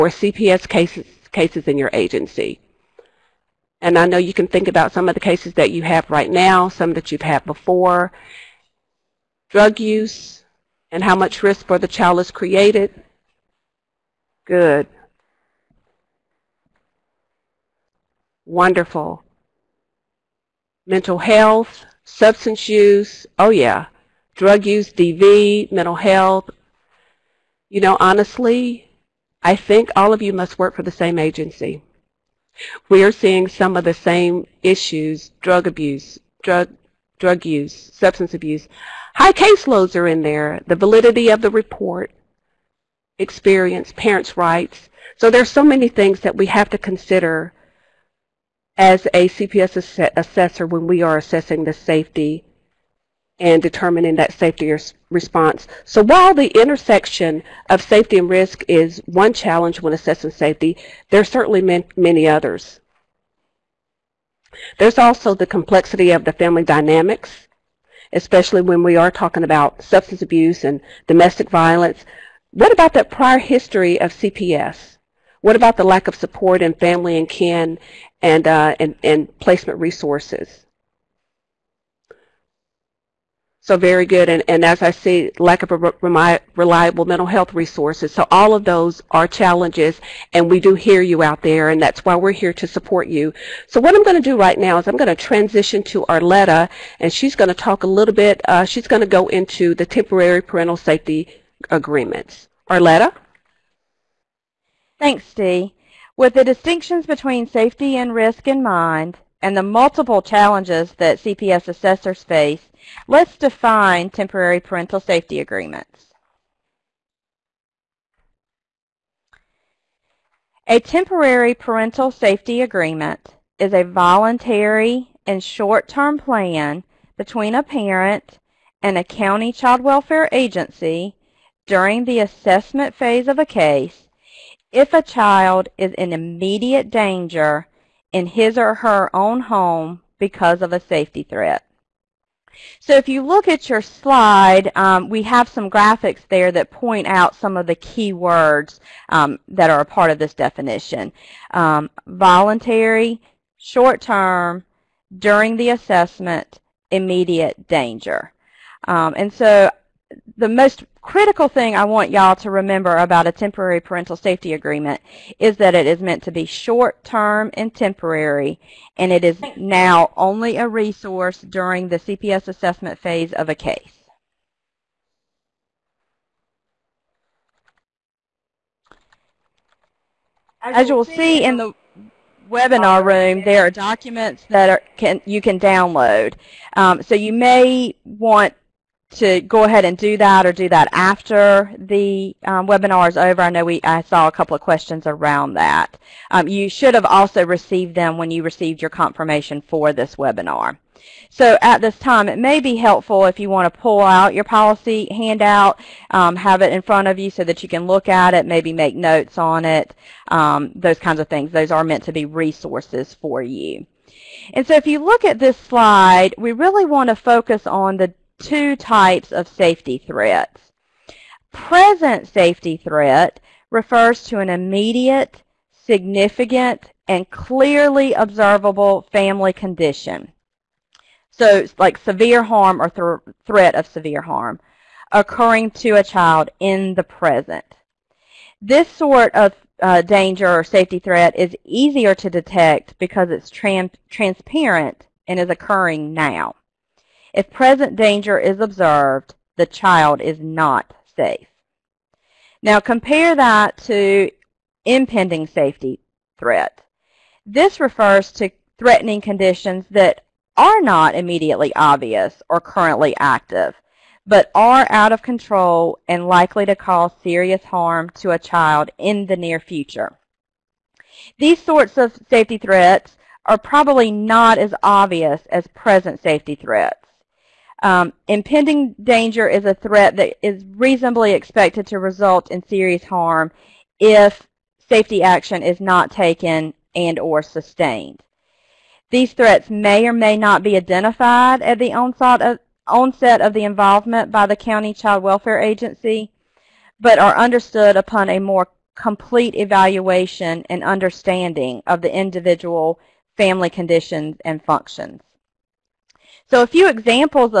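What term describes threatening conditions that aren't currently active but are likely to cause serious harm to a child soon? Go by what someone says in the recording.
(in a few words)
impending safety threat.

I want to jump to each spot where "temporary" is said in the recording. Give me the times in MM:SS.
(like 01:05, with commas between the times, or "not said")
01:39, 01:54, 02:00, 02:43, 02:47.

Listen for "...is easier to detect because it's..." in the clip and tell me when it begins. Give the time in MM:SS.
04:01.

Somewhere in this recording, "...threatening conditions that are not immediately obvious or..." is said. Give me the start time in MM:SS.
04:18.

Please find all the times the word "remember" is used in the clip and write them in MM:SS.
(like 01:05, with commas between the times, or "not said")
02:42.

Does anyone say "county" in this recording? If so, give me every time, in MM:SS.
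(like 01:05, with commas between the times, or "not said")
02:09, 04:54.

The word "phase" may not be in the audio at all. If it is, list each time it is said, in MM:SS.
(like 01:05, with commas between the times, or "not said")
02:12, 02:52.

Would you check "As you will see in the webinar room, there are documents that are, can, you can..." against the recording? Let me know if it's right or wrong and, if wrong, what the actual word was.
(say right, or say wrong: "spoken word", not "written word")
right.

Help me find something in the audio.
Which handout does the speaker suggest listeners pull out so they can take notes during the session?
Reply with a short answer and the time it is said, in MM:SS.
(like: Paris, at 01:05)
policy handout, at 03:24.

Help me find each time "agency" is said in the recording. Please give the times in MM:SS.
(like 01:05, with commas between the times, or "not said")
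00:01, 00:31, 02:10, 04:55.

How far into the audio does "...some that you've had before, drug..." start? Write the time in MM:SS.
00:06.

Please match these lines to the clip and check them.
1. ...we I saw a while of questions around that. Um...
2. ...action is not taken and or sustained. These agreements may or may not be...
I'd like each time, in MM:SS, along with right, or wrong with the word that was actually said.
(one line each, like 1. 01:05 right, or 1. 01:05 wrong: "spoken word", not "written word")
1. 03:13 wrong: "couple", not "while"
2. 04:45 wrong: "threats", not "agreements".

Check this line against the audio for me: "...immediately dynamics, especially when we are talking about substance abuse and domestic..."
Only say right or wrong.
wrong.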